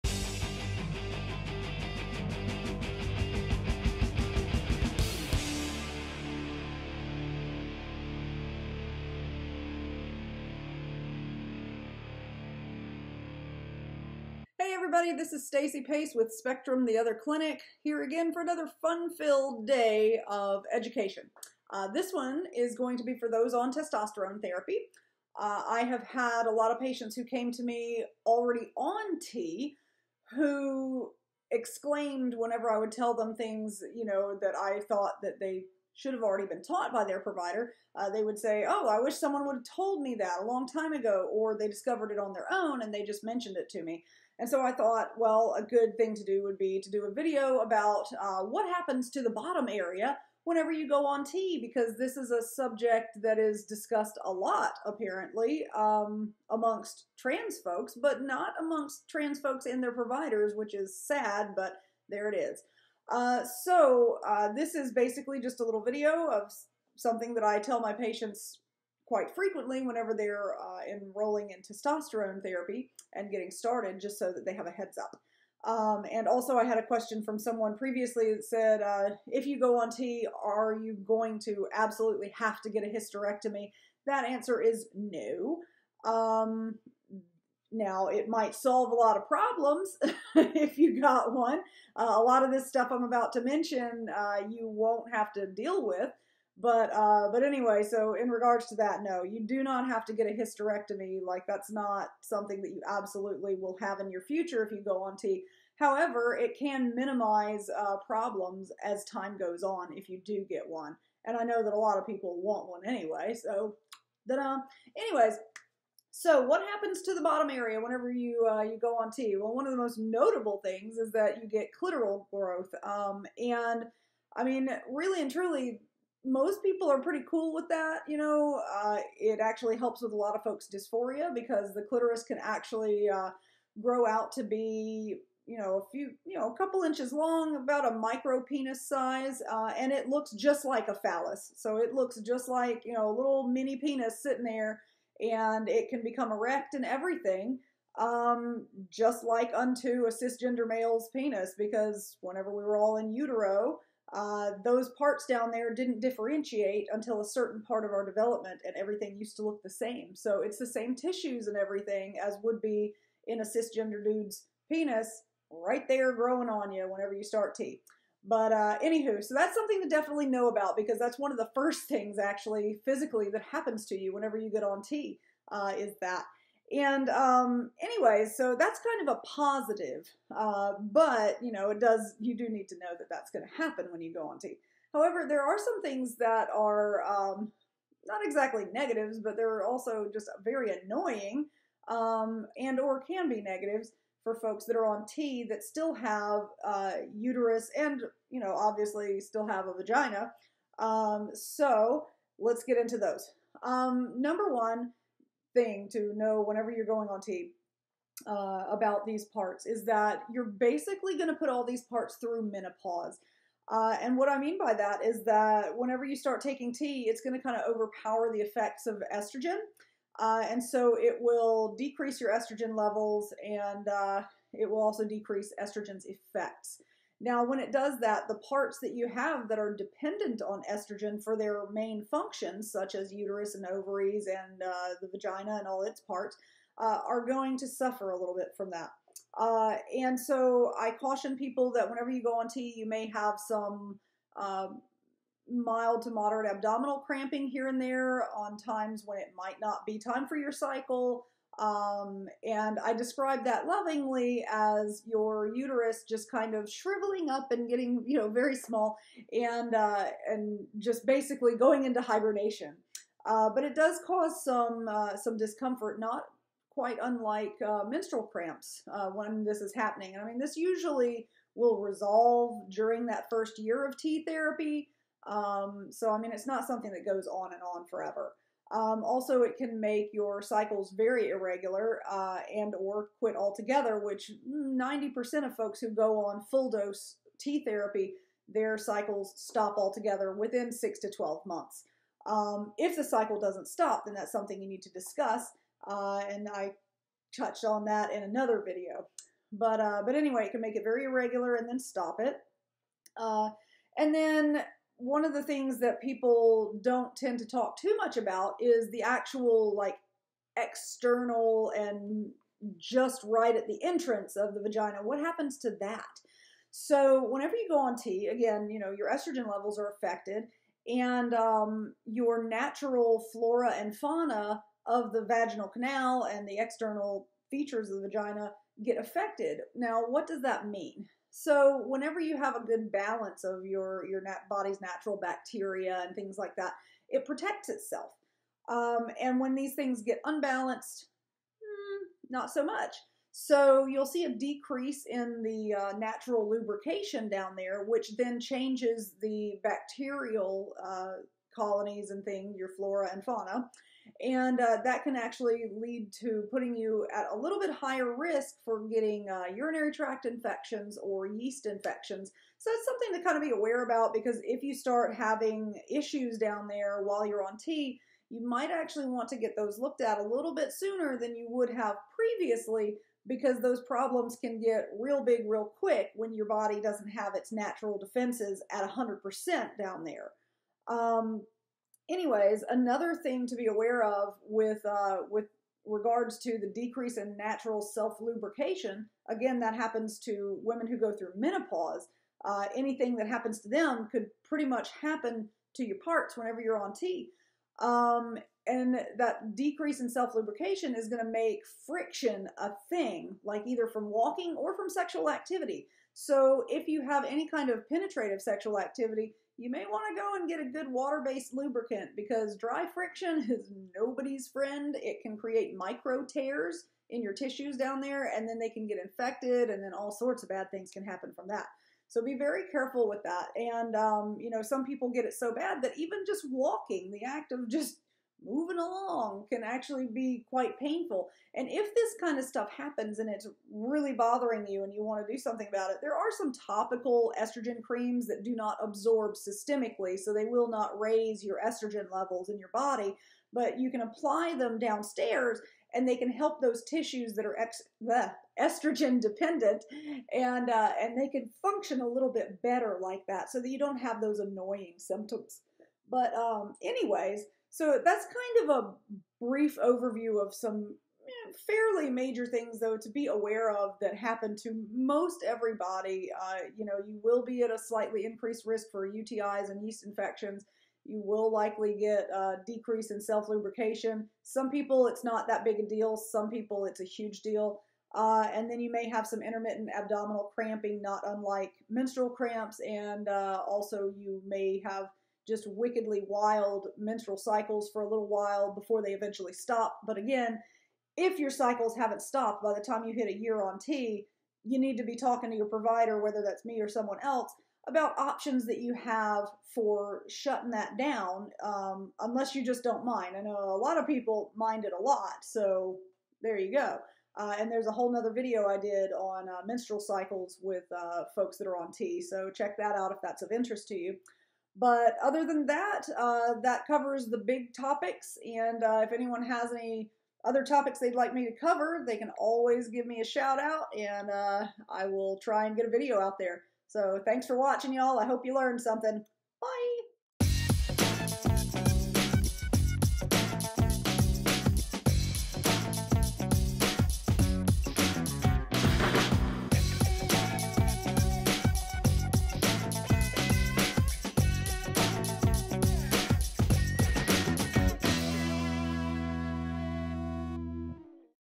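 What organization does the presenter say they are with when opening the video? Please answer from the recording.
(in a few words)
Spectrum the Other Clinic.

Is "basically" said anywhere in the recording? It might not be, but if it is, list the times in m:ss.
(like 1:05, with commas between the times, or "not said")
1:04, 3:30, 4:21.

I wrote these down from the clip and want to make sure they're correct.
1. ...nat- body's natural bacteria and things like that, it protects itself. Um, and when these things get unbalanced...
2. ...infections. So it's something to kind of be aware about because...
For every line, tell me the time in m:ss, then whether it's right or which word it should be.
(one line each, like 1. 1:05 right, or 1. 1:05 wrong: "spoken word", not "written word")
1. 5:34 right
2. 6:01 right.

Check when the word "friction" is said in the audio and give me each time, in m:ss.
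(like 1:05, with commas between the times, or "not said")
6:41, 6:52.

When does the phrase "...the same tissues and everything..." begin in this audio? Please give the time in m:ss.
2:40.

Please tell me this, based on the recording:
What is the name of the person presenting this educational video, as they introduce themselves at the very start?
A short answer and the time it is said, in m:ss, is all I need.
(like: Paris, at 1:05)
Stacy Pace, at 0:15.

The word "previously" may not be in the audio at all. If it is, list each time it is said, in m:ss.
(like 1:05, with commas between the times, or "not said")
1:17, 6:12.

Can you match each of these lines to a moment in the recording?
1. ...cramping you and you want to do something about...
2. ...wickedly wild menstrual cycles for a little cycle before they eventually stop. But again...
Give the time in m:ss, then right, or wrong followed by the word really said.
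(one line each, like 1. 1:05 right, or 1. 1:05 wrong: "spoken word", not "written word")
1. 7:14 wrong: "bothering", not "cramping"
2. 8:05 wrong: "while", not "cycle".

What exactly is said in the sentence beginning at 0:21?
Uh, this one is going to be for those on testosterone therapy.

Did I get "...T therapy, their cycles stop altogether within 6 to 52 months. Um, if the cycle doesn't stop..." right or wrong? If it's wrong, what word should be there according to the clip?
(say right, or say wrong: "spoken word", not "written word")
wrong: "12", not "52".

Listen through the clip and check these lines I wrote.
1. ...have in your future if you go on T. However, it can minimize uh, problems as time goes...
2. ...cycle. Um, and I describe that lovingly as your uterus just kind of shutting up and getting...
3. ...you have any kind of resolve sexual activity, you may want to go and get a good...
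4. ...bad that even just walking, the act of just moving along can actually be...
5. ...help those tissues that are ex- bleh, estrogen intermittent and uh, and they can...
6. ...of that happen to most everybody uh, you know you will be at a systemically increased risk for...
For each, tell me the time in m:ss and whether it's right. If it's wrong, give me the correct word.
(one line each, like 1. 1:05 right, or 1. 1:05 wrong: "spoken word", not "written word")
1. 1:43 right
2. 4:10 wrong: "shriveling", not "shutting"
3. 6:46 wrong: "penetrative", not "resolve"
4. 7:05 right
5. 7:26 wrong: "dependent", not "intermittent"
6. 7:43 wrong: "slightly", not "systemically".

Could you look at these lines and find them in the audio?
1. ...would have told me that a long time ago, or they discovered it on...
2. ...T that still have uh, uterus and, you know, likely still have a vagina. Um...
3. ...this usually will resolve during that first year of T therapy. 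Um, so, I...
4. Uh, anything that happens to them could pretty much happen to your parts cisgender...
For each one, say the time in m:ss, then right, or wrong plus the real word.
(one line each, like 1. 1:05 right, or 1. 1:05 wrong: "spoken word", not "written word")
1. 0:39 right
2. 3:15 wrong: "obviously", not "likely"
3. 4:30 right
4. 6:32 wrong: "whenever", not "cisgender".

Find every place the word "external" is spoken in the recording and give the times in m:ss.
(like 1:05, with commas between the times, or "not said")
5:10, 5:26.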